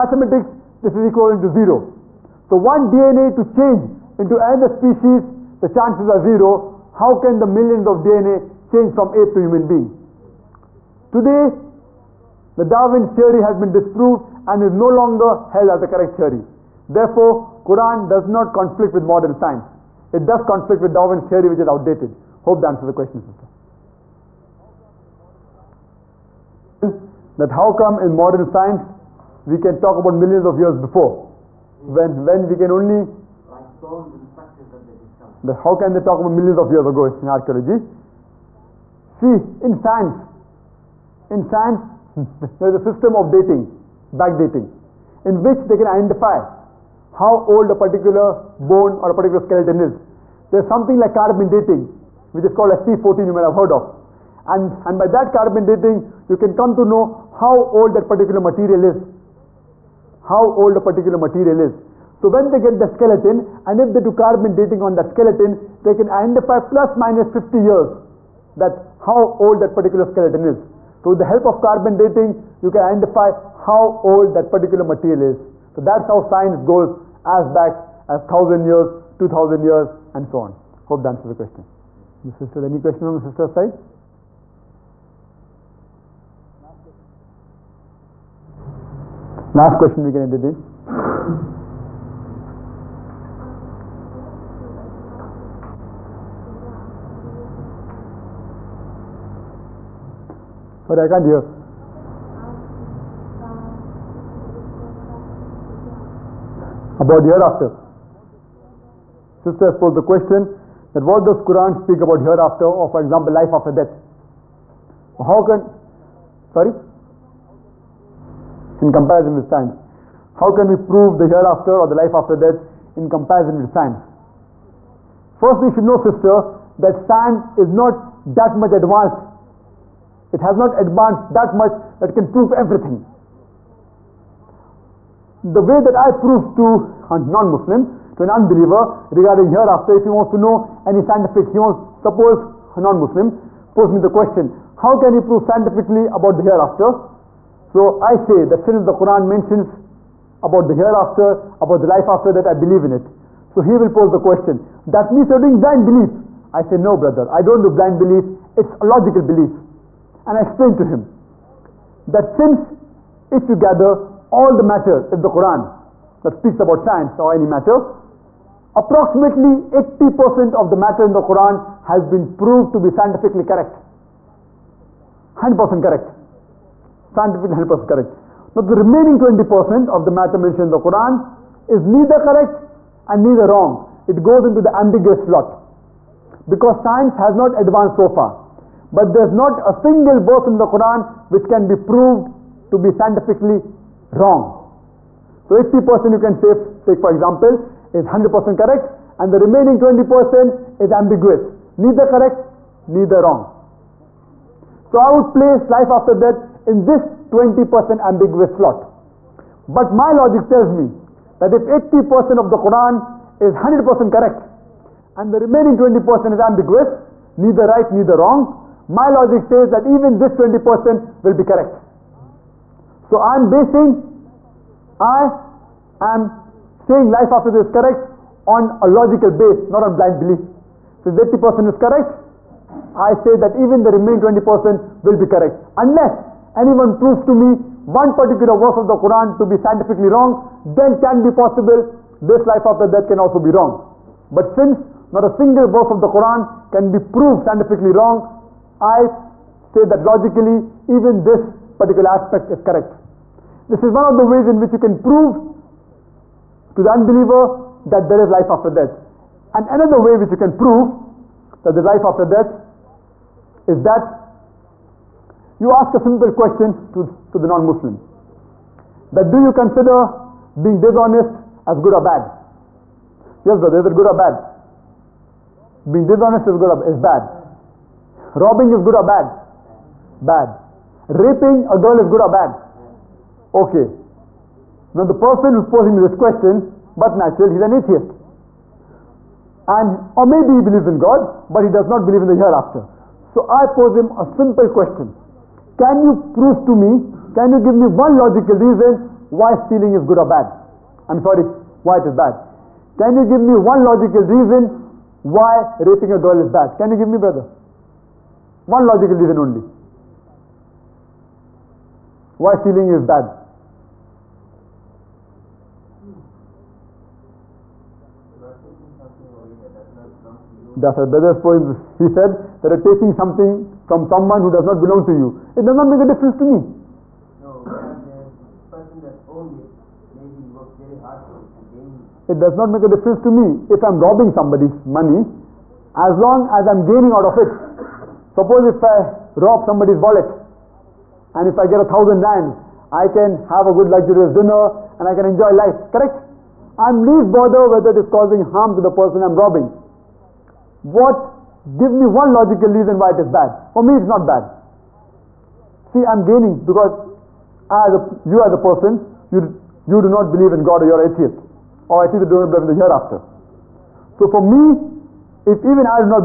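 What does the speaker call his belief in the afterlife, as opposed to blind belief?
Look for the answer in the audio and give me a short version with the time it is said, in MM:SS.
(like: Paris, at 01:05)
logical belief, at 02:38.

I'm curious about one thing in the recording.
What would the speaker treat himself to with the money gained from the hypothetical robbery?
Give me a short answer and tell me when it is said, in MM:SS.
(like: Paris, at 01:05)
luxurious dinner, at 05:43.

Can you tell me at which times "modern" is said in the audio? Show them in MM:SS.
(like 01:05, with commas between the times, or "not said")
00:19, 00:28.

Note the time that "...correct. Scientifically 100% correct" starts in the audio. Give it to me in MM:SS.
02:55.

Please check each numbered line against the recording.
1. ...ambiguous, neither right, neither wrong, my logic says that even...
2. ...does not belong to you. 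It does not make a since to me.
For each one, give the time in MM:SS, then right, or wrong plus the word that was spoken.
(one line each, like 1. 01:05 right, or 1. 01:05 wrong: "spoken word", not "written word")
1. 03:36 right
2. 05:24 wrong: "difference", not "since".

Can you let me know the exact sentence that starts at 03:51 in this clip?
So if 80% is correct, I say that even the remaining 20% will be correct.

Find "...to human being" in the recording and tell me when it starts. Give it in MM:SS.
00:09.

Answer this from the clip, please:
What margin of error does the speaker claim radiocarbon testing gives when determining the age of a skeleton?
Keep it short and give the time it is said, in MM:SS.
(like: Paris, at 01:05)
plus minus 50 years, at 01:06.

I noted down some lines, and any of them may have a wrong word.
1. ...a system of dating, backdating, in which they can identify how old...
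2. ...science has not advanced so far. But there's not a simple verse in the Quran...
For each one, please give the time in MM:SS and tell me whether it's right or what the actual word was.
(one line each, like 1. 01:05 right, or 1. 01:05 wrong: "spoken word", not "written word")
1. 00:42 right
2. 03:06 wrong: "single", not "simple".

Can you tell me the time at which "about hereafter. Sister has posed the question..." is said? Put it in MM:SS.
01:46.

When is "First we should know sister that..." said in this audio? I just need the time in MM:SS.
02:05.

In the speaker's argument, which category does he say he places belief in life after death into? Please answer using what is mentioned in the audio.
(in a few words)
ambiguous slot.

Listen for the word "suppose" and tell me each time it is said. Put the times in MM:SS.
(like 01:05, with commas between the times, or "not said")
02:22, 05:38.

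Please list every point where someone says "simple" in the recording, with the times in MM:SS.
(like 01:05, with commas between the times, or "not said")
04:25, 04:54.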